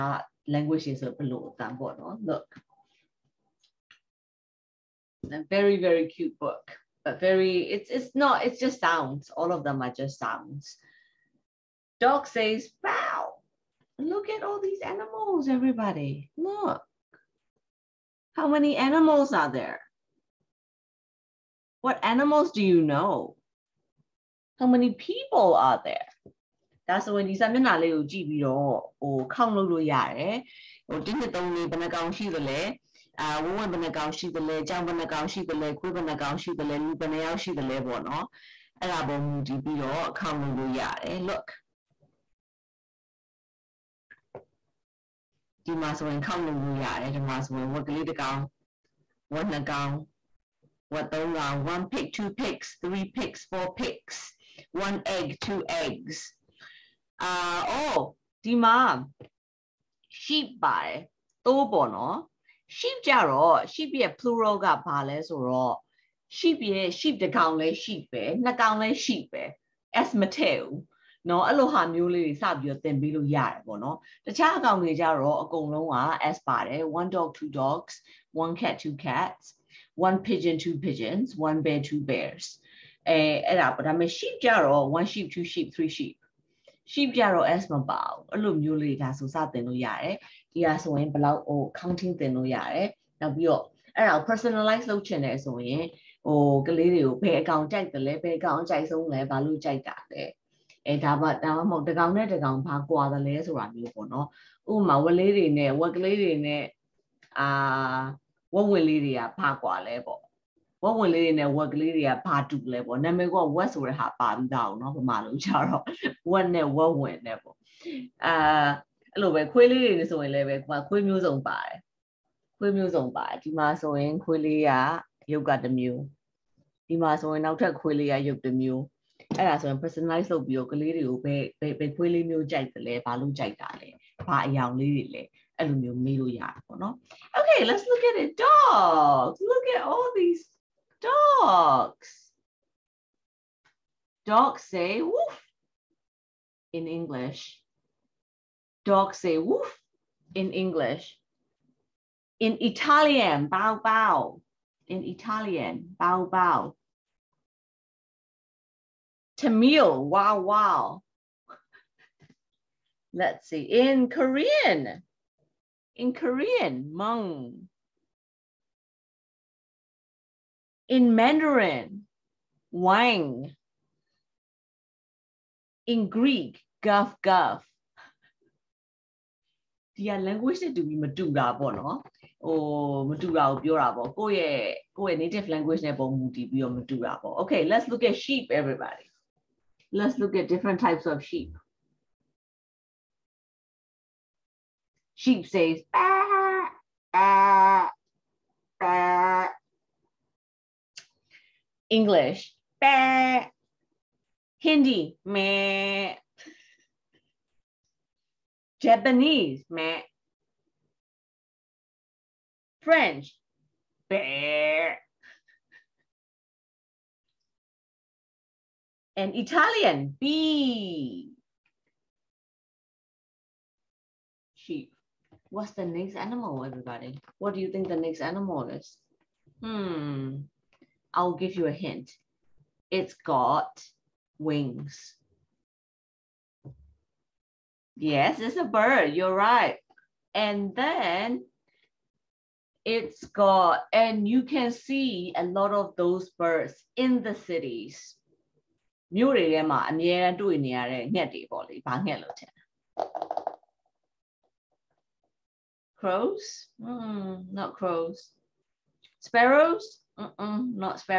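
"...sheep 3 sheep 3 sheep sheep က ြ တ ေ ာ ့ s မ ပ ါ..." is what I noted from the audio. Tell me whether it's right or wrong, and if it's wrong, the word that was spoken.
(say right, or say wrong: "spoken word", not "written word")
wrong: "2", not "3".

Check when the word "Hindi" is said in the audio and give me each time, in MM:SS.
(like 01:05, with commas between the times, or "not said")
03:24.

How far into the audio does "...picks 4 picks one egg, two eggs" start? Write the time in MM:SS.
00:53.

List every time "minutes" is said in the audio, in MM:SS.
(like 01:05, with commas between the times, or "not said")
not said.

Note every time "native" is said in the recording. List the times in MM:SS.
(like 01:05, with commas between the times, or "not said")
03:05.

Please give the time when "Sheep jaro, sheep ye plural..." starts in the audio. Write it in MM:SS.
01:02.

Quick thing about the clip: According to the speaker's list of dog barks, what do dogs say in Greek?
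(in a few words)
guff guff.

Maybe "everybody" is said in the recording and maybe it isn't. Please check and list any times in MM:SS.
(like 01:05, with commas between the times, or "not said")
00:15, 03:08, 03:46.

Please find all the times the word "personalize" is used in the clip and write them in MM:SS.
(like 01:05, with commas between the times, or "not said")
01:34, 02:09.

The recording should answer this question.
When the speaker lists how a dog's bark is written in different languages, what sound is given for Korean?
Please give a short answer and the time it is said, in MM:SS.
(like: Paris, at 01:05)
mung, at 02:46.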